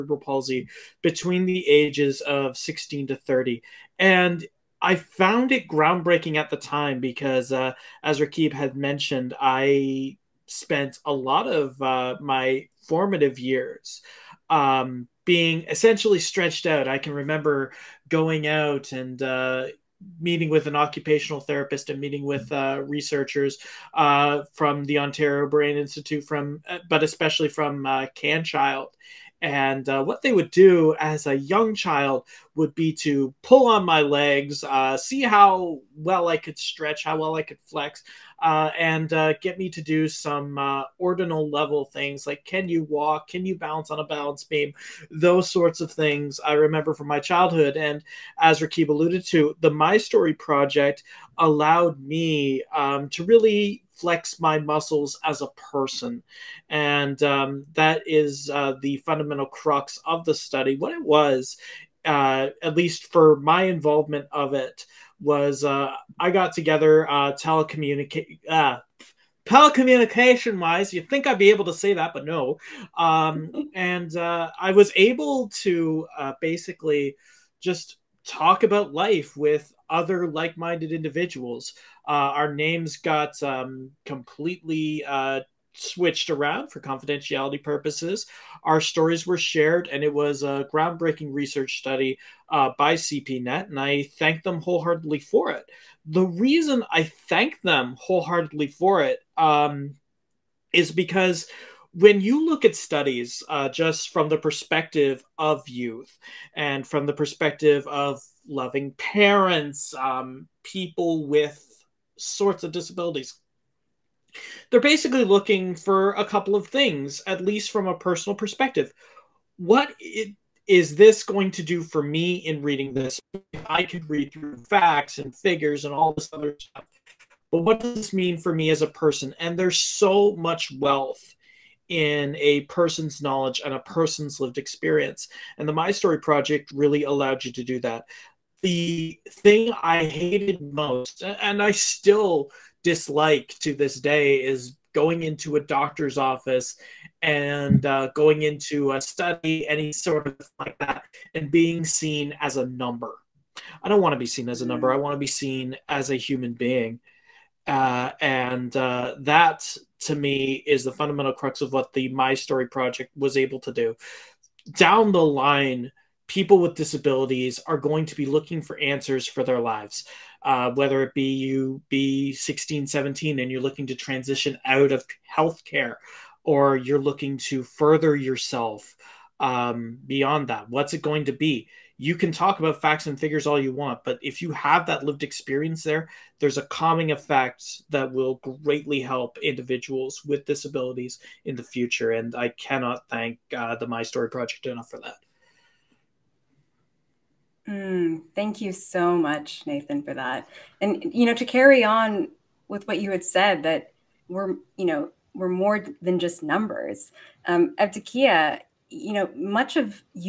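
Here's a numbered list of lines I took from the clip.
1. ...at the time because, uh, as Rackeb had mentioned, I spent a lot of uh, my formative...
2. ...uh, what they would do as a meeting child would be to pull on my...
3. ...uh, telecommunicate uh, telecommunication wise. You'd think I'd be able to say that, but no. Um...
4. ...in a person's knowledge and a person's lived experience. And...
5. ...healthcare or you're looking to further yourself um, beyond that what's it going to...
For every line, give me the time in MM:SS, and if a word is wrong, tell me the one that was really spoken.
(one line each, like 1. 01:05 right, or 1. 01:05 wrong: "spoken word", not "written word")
1. 00:06 right
2. 00:29 wrong: "young", not "meeting"
3. 01:07 right
4. 02:11 right
5. 02:55 right.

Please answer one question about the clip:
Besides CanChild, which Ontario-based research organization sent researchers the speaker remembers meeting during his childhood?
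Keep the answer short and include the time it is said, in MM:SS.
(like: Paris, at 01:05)
Ontario Brain Institute, at 00:24.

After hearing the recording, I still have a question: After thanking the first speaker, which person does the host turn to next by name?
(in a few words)
Evdokia.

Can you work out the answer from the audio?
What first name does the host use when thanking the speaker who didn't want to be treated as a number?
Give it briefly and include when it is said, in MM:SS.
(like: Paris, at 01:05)
Nathan, at 03:19.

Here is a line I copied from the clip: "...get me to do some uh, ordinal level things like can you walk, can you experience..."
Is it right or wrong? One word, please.
wrong.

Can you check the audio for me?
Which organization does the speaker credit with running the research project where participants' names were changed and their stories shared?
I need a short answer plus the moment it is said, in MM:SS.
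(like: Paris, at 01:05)
CPNet, at 01:32.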